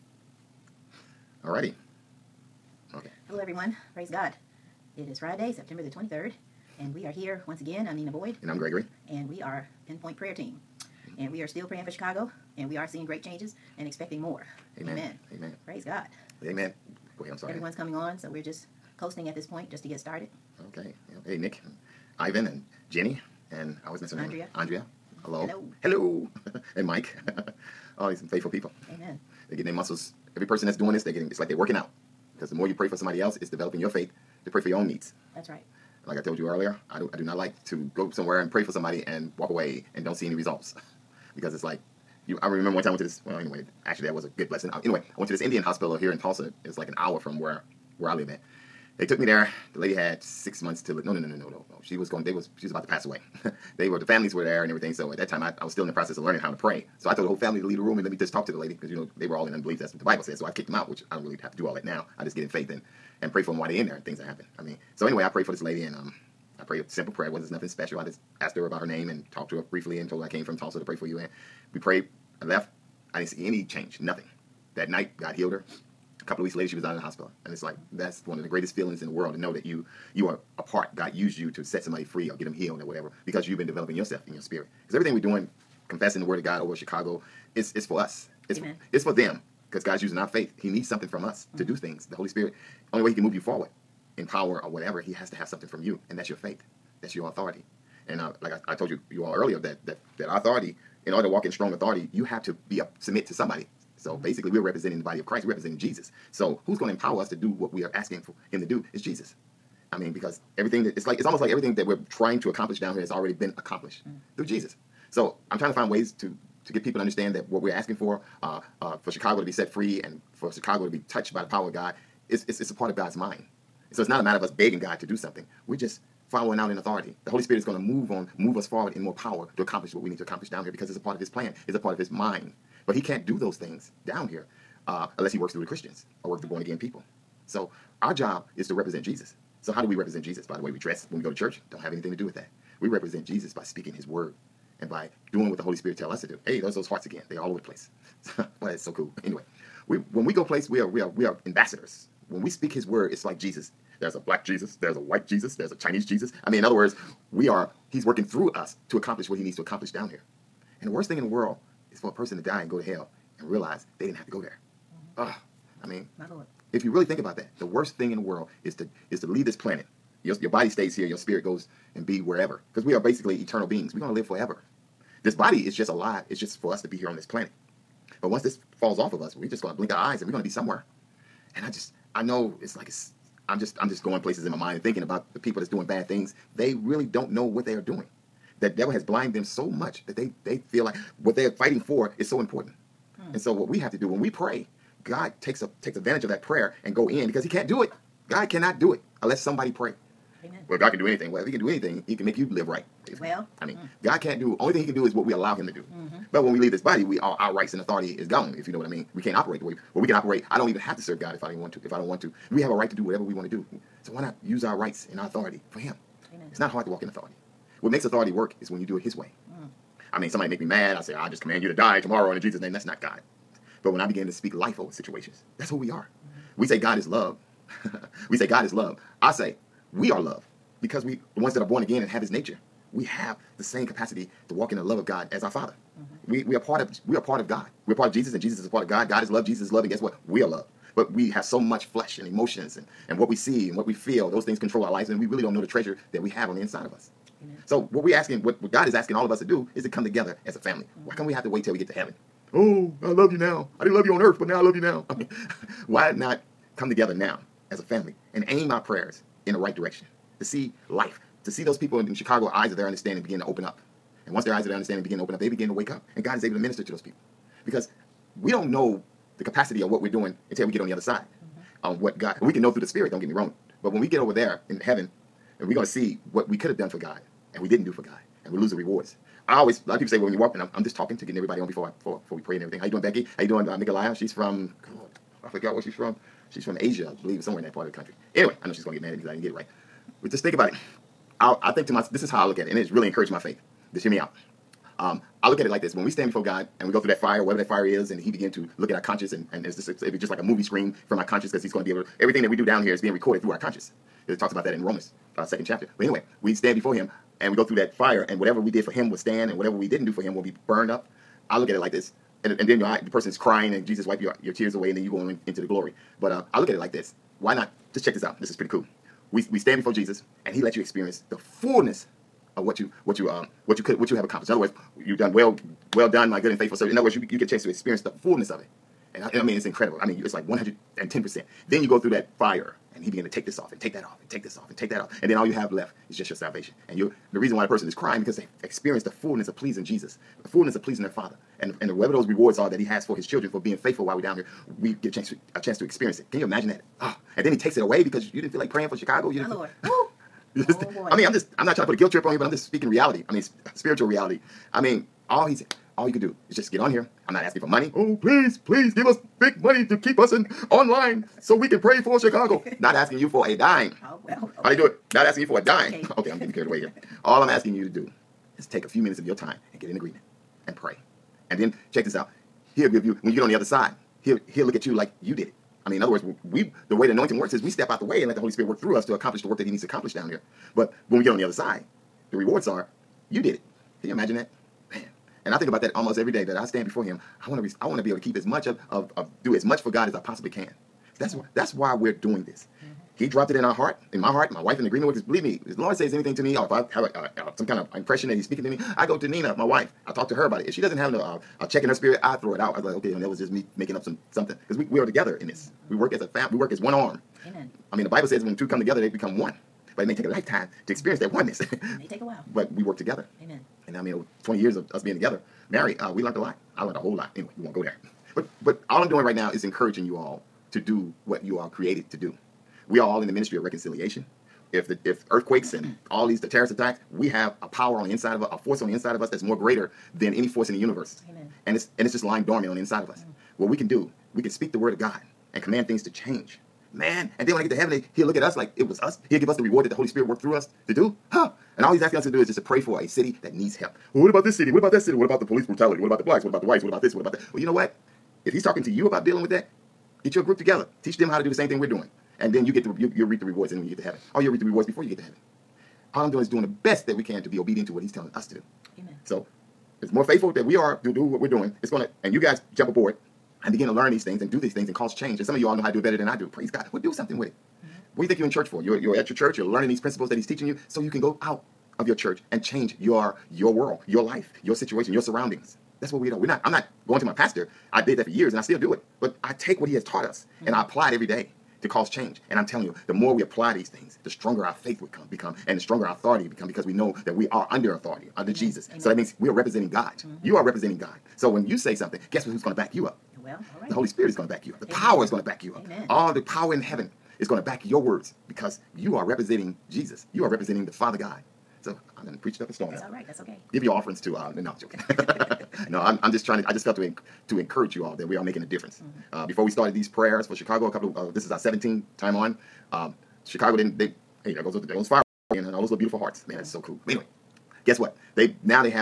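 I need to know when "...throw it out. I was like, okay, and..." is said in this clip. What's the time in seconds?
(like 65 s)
402 s.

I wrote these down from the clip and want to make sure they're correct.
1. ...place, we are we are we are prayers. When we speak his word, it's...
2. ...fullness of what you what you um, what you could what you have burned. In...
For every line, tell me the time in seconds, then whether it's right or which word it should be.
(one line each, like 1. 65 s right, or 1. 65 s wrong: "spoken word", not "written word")
1. 150 s wrong: "ambassadors", not "prayers"
2. 321 s wrong: "accomplished", not "burned".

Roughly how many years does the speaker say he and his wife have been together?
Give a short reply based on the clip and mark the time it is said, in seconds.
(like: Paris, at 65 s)
Over 20 years, at 414 s.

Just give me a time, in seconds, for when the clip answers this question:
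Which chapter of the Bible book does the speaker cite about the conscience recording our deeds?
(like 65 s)
305 s.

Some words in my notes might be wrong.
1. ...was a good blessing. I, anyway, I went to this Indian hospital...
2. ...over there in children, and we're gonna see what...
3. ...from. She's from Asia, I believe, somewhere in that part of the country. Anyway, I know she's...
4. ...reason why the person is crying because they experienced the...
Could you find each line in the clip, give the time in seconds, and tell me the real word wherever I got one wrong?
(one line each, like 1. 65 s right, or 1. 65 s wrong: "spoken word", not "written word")
1. 44 s right
2. 274 s wrong: "heaven", not "children"
3. 285 s right
4. 337 s right.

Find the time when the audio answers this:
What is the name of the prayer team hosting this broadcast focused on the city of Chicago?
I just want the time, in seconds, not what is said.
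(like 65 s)
9 s.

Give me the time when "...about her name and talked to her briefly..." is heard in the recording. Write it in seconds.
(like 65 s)
68 s.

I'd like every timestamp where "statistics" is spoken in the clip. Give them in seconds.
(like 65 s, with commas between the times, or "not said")
not said.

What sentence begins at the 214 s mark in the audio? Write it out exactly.
So why not use our rights and our authority for him?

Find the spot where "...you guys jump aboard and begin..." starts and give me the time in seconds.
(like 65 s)
462 s.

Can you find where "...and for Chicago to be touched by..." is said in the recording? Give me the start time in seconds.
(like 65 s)
120 s.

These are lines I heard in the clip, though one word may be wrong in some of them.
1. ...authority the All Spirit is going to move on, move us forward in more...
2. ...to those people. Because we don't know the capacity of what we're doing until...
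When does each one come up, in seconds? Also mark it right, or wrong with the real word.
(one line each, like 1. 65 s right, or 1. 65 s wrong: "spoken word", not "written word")
1. 126 s wrong: "Holy", not "All"
2. 266 s right.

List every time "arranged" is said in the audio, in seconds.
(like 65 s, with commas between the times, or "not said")
not said.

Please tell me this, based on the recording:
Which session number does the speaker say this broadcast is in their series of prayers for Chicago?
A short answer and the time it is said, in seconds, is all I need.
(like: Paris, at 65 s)
17th, at 511 s.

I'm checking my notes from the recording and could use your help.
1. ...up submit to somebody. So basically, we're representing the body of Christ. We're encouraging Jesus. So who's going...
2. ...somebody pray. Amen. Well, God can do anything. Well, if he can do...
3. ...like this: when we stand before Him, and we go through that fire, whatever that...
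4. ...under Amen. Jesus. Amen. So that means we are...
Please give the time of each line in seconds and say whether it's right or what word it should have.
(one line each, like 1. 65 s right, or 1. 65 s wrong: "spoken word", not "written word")
1. 102 s wrong: "representing", not "encouraging"
2. 199 s right
3. 295 s wrong: "God", not "Him"
4. 488 s right.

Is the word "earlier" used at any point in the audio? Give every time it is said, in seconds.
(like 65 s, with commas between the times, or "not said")
36 s, 99 s.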